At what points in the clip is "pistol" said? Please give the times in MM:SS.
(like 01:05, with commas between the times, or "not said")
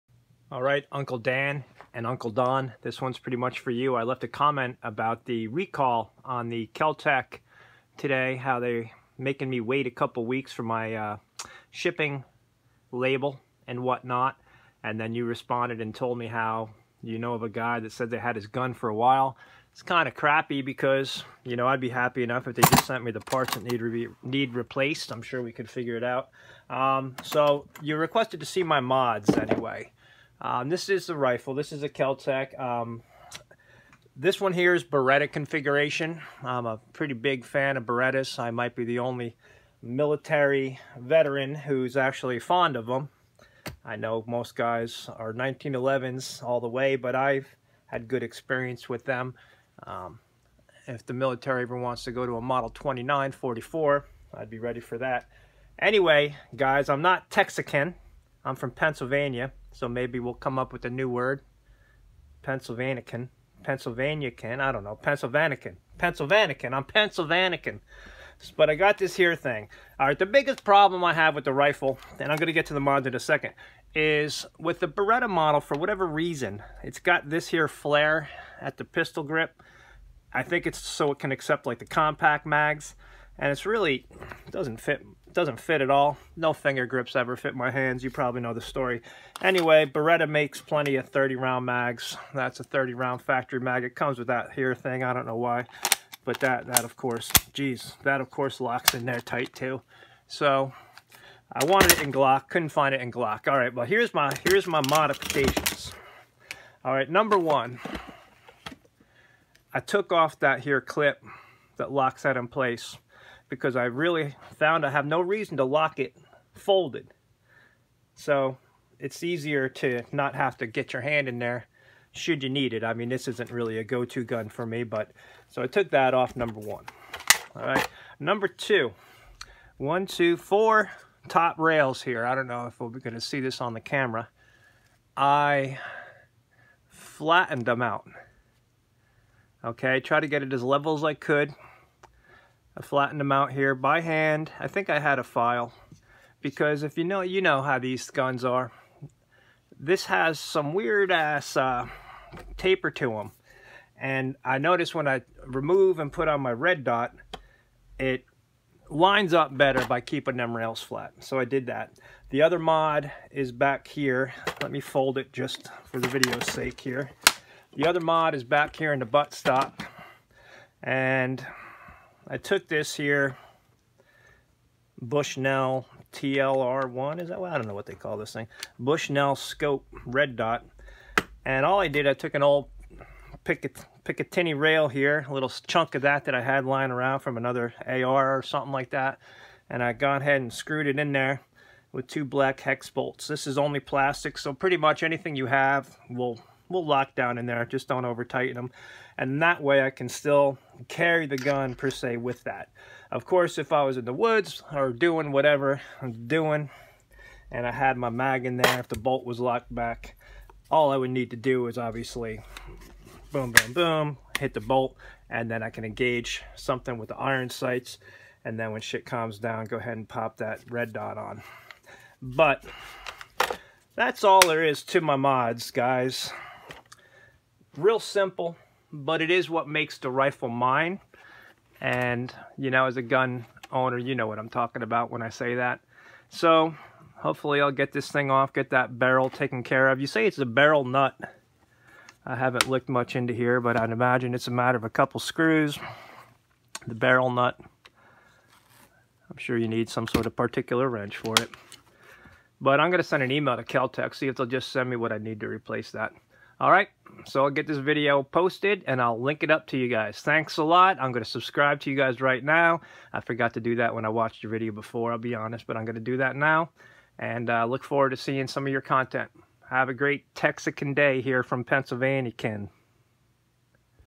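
01:18.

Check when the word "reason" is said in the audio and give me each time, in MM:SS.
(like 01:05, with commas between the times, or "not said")
01:16, 01:55.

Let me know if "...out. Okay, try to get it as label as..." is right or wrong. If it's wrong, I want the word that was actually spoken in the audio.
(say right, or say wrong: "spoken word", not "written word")
wrong: "level", not "label".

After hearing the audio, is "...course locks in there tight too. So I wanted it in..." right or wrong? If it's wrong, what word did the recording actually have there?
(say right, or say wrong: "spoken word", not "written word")
right.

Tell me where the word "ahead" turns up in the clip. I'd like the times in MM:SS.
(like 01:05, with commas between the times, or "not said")
03:10, 03:39.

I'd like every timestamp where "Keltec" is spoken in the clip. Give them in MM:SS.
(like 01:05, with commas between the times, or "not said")
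00:06, 04:13.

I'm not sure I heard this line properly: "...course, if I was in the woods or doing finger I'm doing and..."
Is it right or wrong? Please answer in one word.
wrong.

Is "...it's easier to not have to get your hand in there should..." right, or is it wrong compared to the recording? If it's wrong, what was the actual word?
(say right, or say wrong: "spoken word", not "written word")
right.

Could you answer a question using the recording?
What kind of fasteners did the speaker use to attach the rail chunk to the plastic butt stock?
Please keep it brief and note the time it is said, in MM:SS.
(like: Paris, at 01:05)
Black hex bolts, at 03:12.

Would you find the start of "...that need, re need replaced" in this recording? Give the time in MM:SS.
00:23.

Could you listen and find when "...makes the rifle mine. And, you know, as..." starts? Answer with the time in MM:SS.
03:49.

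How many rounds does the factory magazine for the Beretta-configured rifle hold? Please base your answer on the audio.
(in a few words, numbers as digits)
30.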